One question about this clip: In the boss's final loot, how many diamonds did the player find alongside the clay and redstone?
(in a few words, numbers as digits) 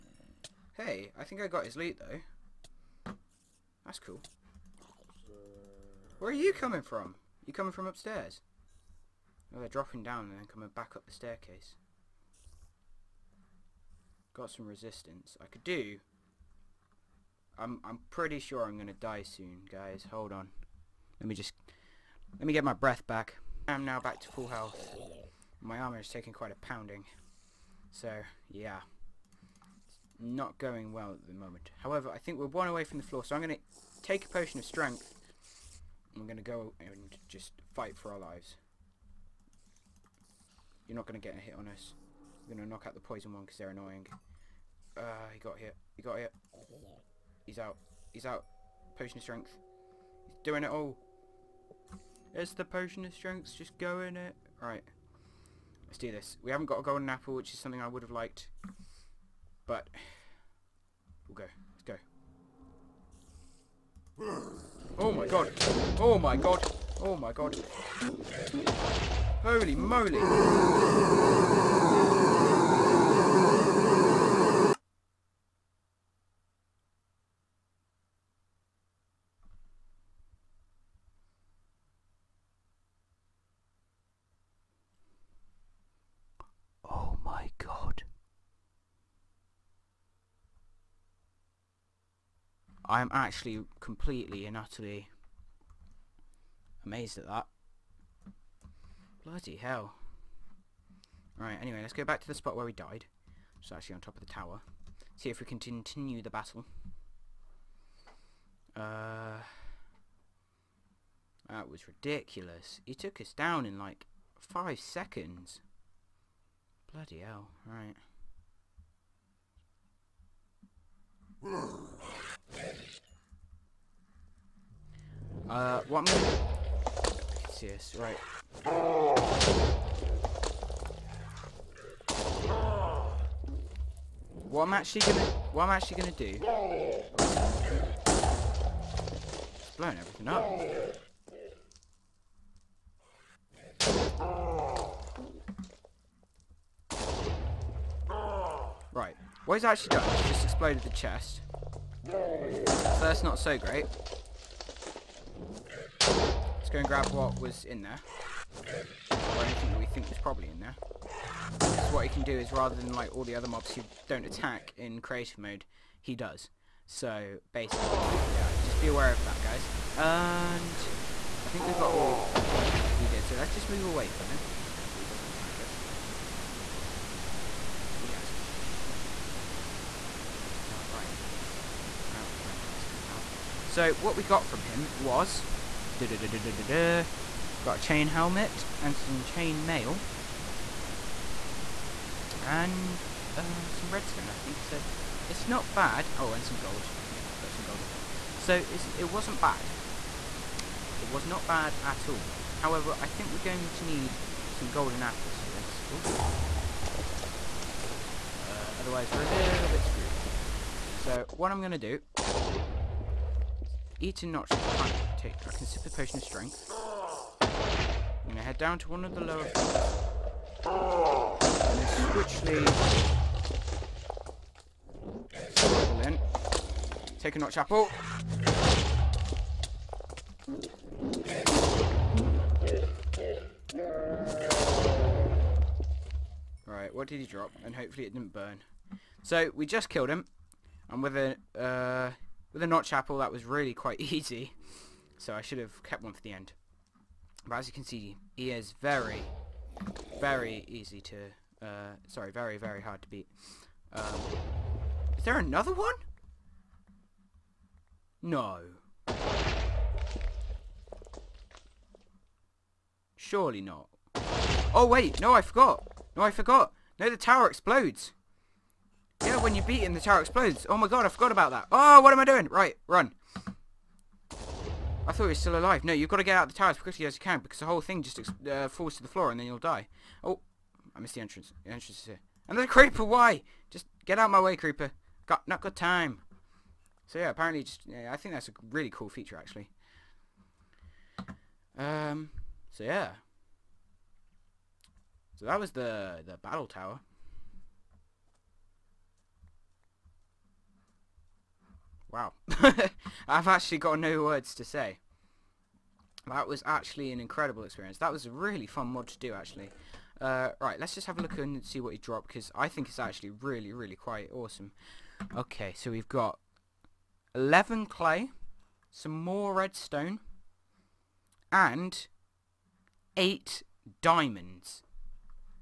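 8.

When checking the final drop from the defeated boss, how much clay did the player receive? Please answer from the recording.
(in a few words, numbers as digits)
11.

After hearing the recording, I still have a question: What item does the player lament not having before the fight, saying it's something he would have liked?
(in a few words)
Golden apple.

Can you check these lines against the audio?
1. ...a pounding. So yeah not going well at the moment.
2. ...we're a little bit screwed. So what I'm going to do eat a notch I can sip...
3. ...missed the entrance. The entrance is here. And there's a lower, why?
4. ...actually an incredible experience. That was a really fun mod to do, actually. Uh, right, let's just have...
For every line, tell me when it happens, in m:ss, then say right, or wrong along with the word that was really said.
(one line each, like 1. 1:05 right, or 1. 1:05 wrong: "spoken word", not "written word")
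1. 0:26 right
2. 3:29 right
3. 4:41 wrong: "creeper", not "lower"
4. 5:06 right.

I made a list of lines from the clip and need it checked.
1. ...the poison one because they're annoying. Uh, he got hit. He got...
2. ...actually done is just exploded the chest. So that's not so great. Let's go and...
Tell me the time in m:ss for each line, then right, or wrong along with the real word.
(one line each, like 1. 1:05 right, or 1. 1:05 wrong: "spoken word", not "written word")
1. 0:42 right
2. 2:29 right.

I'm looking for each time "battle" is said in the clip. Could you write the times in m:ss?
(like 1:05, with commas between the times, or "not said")
1:46, 4:56.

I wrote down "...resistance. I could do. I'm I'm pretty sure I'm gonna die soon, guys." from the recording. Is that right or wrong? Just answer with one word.
right.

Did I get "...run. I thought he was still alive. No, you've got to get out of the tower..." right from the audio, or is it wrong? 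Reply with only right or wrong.
right.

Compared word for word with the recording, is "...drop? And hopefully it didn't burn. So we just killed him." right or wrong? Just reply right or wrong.
right.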